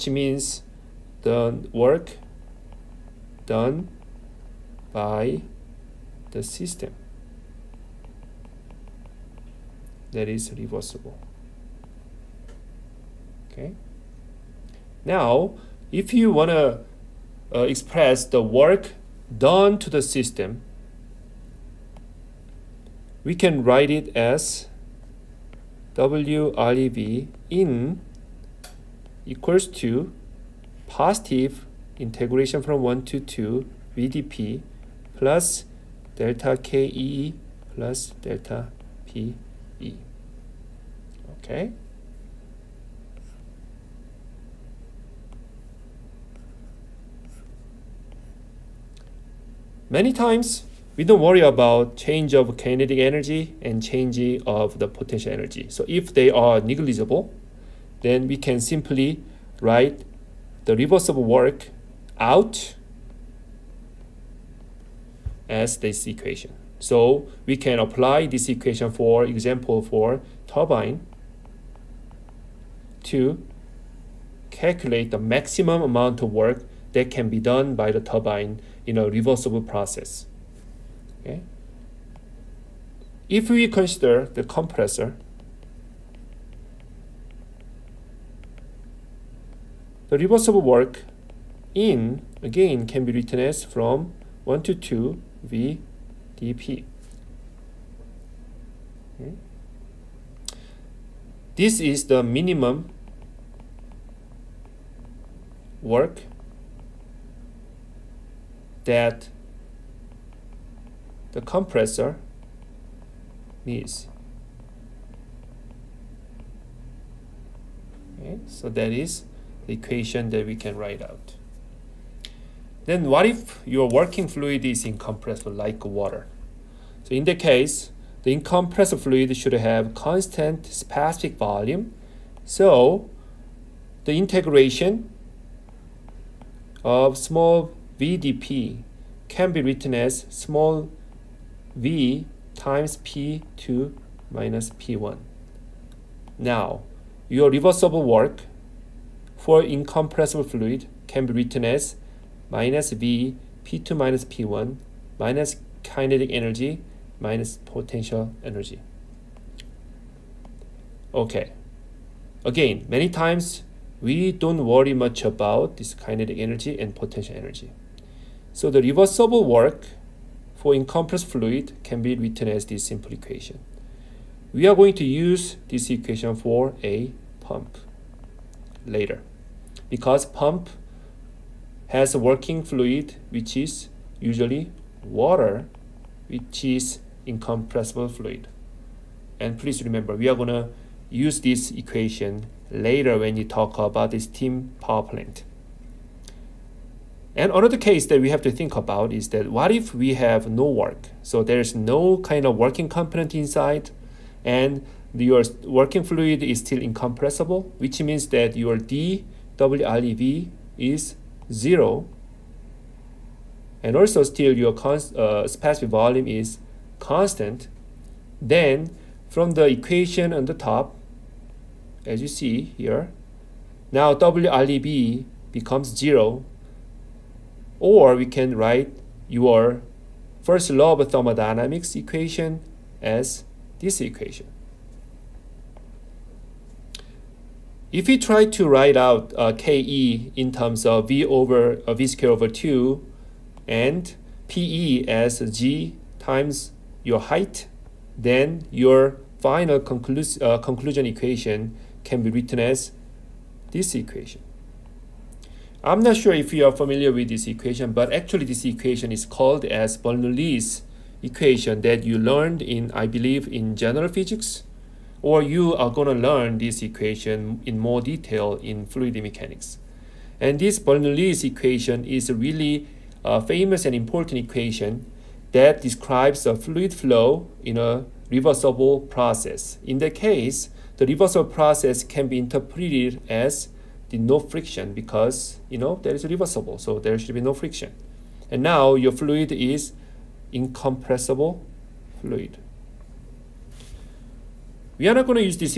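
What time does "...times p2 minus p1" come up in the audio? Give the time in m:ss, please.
2:22.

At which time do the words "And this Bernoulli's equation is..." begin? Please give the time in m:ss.
4:30.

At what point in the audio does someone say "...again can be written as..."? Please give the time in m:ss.
1:32.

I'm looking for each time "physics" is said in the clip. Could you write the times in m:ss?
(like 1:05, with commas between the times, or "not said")
4:24.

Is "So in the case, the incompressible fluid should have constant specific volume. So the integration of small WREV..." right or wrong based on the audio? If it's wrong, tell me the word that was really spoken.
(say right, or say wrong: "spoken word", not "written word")
wrong: "VDP", not "WREV".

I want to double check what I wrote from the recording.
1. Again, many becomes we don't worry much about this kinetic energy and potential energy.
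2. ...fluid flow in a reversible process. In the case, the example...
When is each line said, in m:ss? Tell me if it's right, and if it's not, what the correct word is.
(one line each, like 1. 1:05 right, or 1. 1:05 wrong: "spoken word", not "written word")
1. 2:42 wrong: "times", not "becomes"
2. 4:36 wrong: "reversible", not "example".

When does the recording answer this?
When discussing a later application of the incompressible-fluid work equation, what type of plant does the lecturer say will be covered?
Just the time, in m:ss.
3:14.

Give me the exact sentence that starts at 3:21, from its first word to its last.
So there's no kind of working component inside and your working fluid is still incompressible, which means that your dWLEV is zero.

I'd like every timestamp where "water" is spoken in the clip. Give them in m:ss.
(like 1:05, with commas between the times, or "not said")
2:05, 3:05.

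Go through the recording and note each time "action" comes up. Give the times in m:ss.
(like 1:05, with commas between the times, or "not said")
not said.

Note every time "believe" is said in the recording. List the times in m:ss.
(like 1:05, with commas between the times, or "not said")
4:23.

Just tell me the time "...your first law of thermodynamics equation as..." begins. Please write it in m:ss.
3:49.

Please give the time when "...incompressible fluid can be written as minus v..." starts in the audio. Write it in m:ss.
2:29.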